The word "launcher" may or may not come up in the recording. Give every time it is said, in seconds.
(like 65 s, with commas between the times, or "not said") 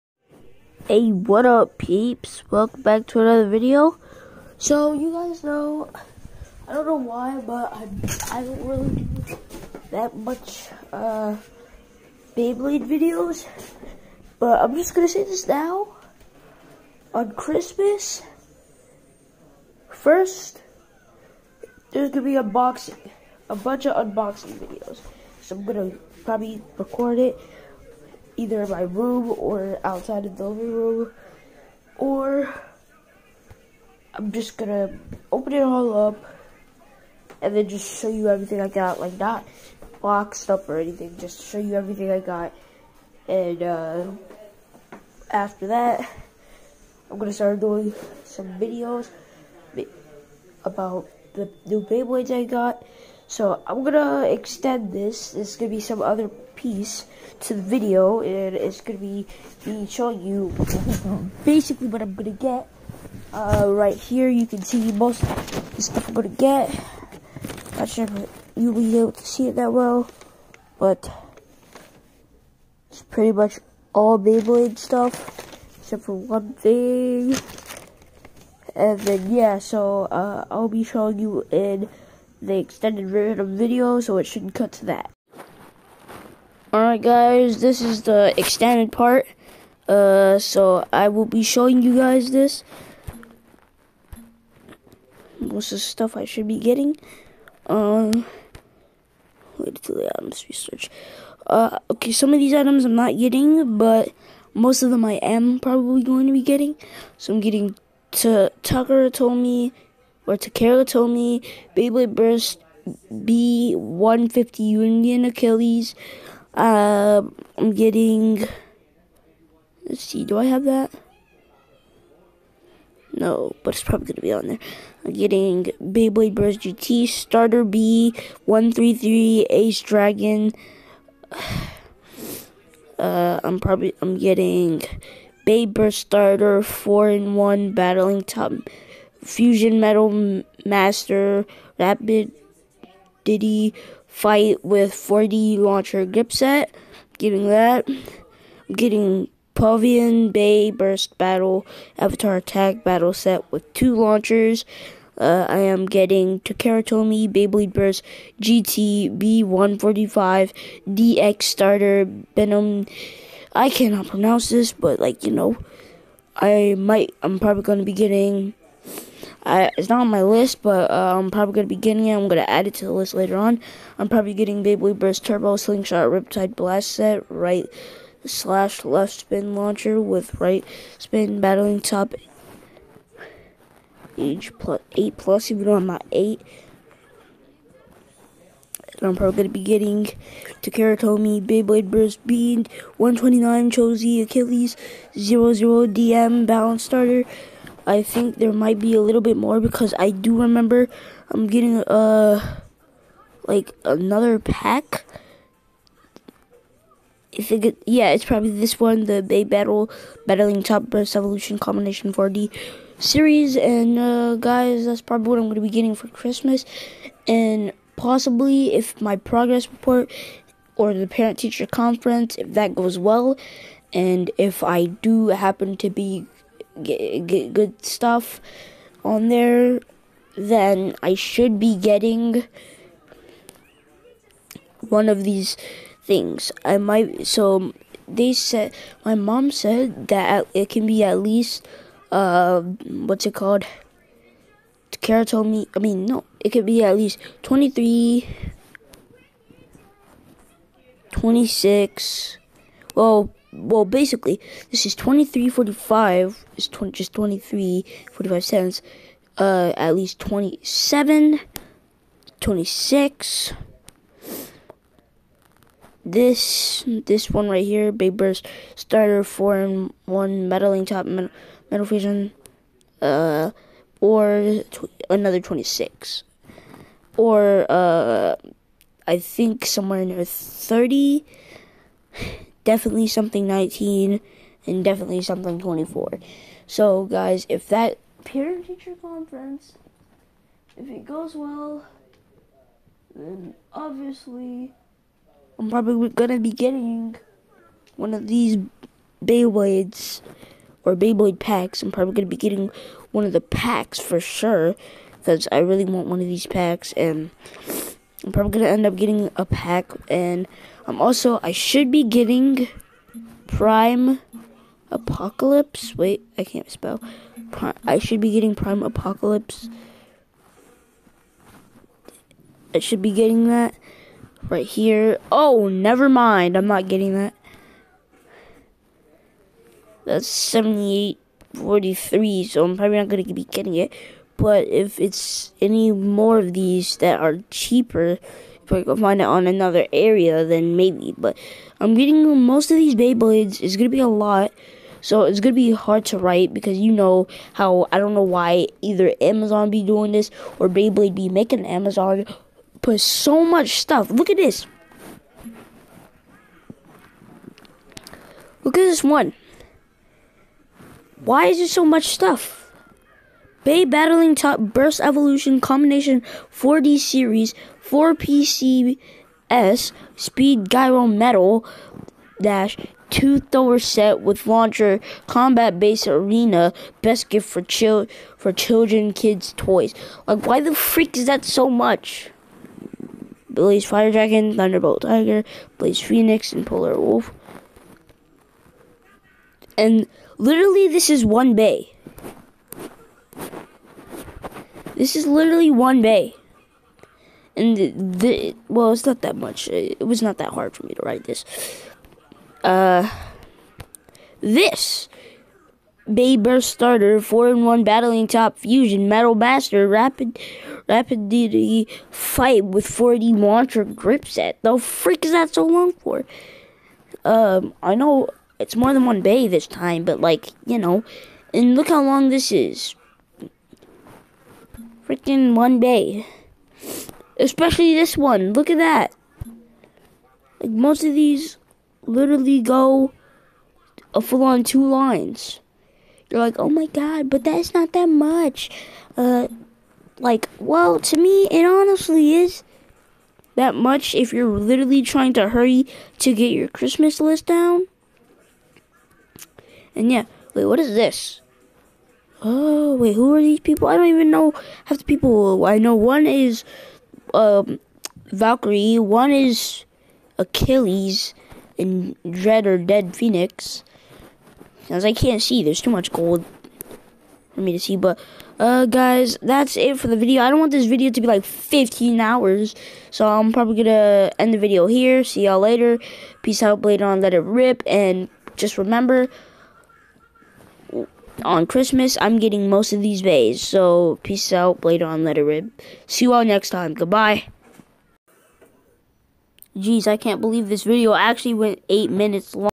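145 s, 153 s, 179 s, 374 s, 413 s.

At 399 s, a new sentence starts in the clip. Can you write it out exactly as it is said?
It was not that hard for me to write this.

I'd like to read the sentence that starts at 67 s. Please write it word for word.
Not sure if you'll be able to see it that well, but it's pretty much all Beyblade stuff, except for one thing.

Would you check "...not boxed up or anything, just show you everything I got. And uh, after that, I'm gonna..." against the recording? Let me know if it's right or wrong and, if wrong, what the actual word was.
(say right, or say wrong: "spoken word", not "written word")
right.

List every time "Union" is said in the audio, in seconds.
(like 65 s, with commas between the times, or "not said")
114 s.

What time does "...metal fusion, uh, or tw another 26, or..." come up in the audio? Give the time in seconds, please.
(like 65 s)
271 s.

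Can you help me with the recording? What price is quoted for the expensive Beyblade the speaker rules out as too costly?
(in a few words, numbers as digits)
78.43.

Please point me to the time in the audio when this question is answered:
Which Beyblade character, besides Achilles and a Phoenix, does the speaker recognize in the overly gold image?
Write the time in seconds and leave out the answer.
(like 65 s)
458 s.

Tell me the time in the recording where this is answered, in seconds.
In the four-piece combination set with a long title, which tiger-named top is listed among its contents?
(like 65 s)
384 s.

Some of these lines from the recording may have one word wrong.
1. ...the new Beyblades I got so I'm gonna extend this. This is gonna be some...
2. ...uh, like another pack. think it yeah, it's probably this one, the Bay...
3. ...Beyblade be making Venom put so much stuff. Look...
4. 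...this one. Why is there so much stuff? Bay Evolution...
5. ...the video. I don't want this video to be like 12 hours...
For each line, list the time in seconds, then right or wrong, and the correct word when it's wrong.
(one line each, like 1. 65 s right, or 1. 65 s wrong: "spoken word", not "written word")
1. 51 s right
2. 201 s right
3. 350 s wrong: "Amazon", not "Venom"
4. 358 s wrong: "Battling", not "Evolution"
5. 470 s wrong: "15", not "12".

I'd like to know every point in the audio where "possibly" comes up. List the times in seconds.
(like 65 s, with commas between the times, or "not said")
217 s.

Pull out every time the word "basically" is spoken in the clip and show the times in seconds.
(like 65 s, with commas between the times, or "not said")
61 s, 253 s.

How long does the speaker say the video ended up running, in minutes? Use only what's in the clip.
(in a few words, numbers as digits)
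8 minutes.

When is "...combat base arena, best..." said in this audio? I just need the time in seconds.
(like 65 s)
375 s.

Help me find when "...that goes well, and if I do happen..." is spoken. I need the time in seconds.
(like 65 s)
222 s.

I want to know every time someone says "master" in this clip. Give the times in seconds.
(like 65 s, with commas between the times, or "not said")
140 s, 409 s.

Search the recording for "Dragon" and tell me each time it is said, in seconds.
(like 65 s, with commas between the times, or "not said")
129 s, 384 s.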